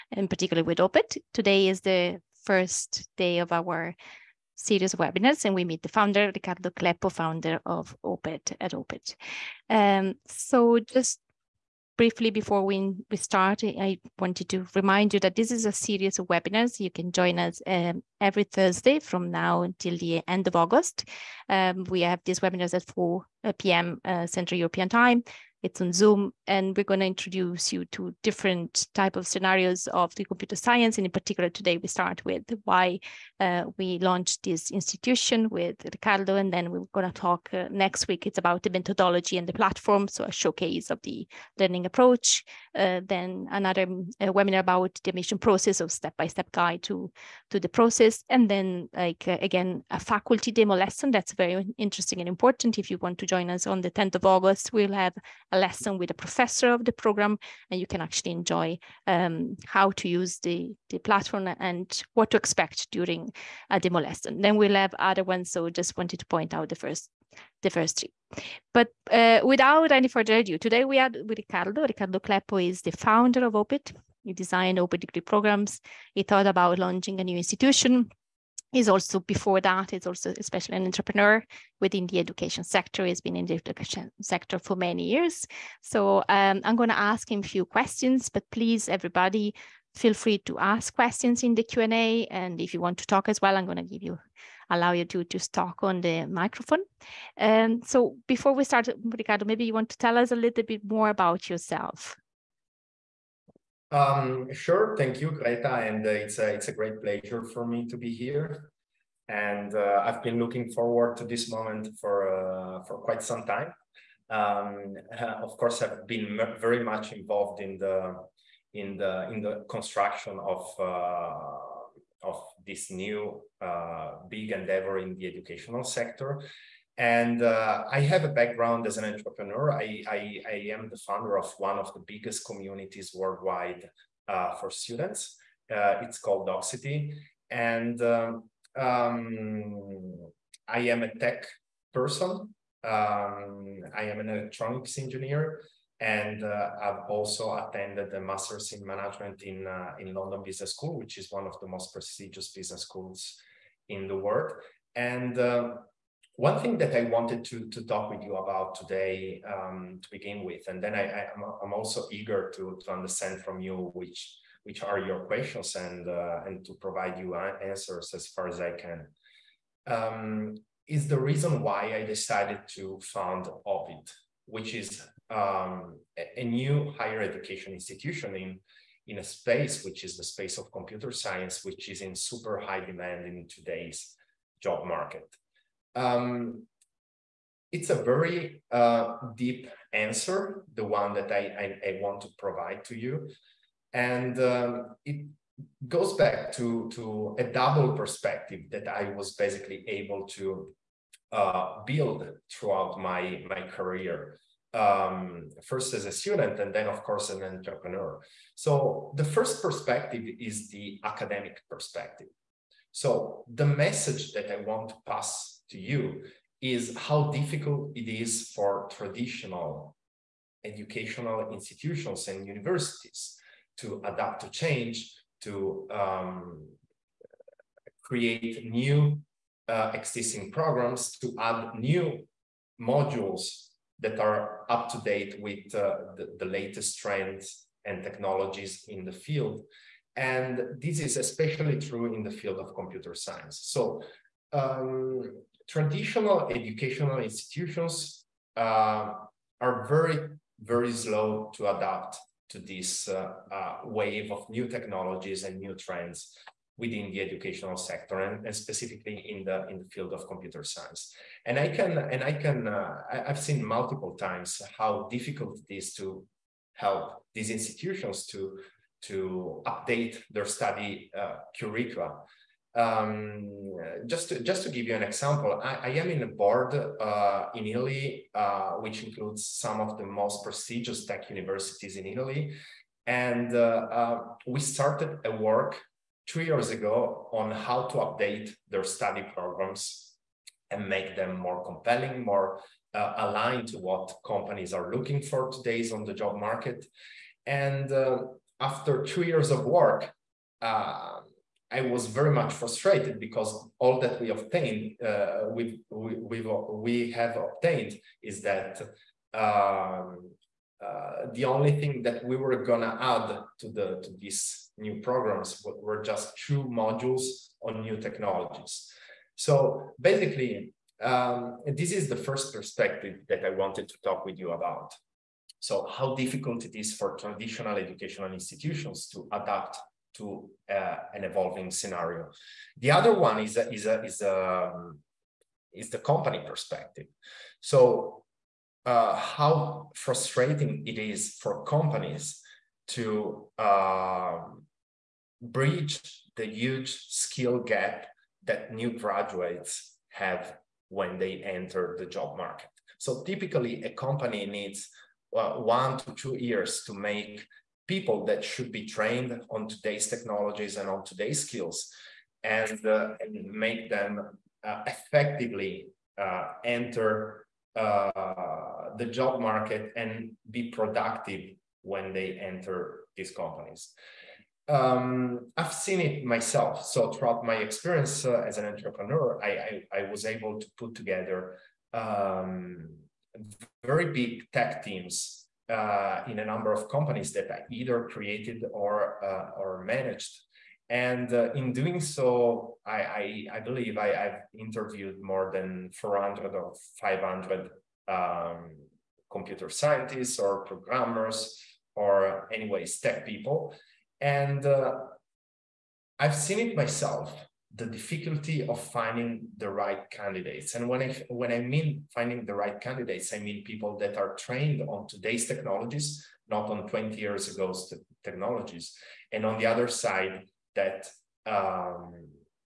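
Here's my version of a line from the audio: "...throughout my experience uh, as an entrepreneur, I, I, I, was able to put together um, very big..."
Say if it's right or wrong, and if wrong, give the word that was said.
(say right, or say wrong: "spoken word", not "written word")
right.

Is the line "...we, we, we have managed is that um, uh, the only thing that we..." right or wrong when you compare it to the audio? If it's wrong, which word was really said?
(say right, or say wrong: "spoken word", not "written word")
wrong: "obtained", not "managed".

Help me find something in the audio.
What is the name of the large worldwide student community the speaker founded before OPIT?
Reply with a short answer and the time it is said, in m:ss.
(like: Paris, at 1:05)
Docsity, at 2:16.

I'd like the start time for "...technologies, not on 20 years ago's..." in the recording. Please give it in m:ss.
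6:55.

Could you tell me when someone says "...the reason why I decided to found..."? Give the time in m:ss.
2:51.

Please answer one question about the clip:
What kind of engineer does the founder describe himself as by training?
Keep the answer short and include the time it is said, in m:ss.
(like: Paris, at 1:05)
Electronics engineer, at 2:24.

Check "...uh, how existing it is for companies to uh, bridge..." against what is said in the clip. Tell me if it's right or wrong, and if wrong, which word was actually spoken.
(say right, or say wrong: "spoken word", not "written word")
wrong: "frustrating", not "existing".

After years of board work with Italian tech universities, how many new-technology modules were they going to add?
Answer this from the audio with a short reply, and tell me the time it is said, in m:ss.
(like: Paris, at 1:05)
2, at 5:16.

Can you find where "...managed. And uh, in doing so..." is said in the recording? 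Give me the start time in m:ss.
6:29.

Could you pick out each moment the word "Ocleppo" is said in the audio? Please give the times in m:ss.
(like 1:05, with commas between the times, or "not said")
0:06, 1:12.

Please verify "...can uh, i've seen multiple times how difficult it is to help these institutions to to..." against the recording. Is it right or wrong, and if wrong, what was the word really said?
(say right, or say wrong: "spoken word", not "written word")
right.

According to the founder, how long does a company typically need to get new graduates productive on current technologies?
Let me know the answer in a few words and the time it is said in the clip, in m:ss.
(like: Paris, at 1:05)
1 to 2 years, at 5:55.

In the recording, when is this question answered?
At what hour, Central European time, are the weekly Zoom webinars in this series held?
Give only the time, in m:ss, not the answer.
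0:22.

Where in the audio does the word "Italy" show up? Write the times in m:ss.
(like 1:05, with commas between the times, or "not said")
4:37, 4:42.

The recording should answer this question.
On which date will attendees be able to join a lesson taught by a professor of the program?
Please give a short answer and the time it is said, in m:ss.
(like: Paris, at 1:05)
10th of August, at 0:53.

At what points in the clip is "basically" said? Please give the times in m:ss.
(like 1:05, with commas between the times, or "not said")
3:19, 5:19.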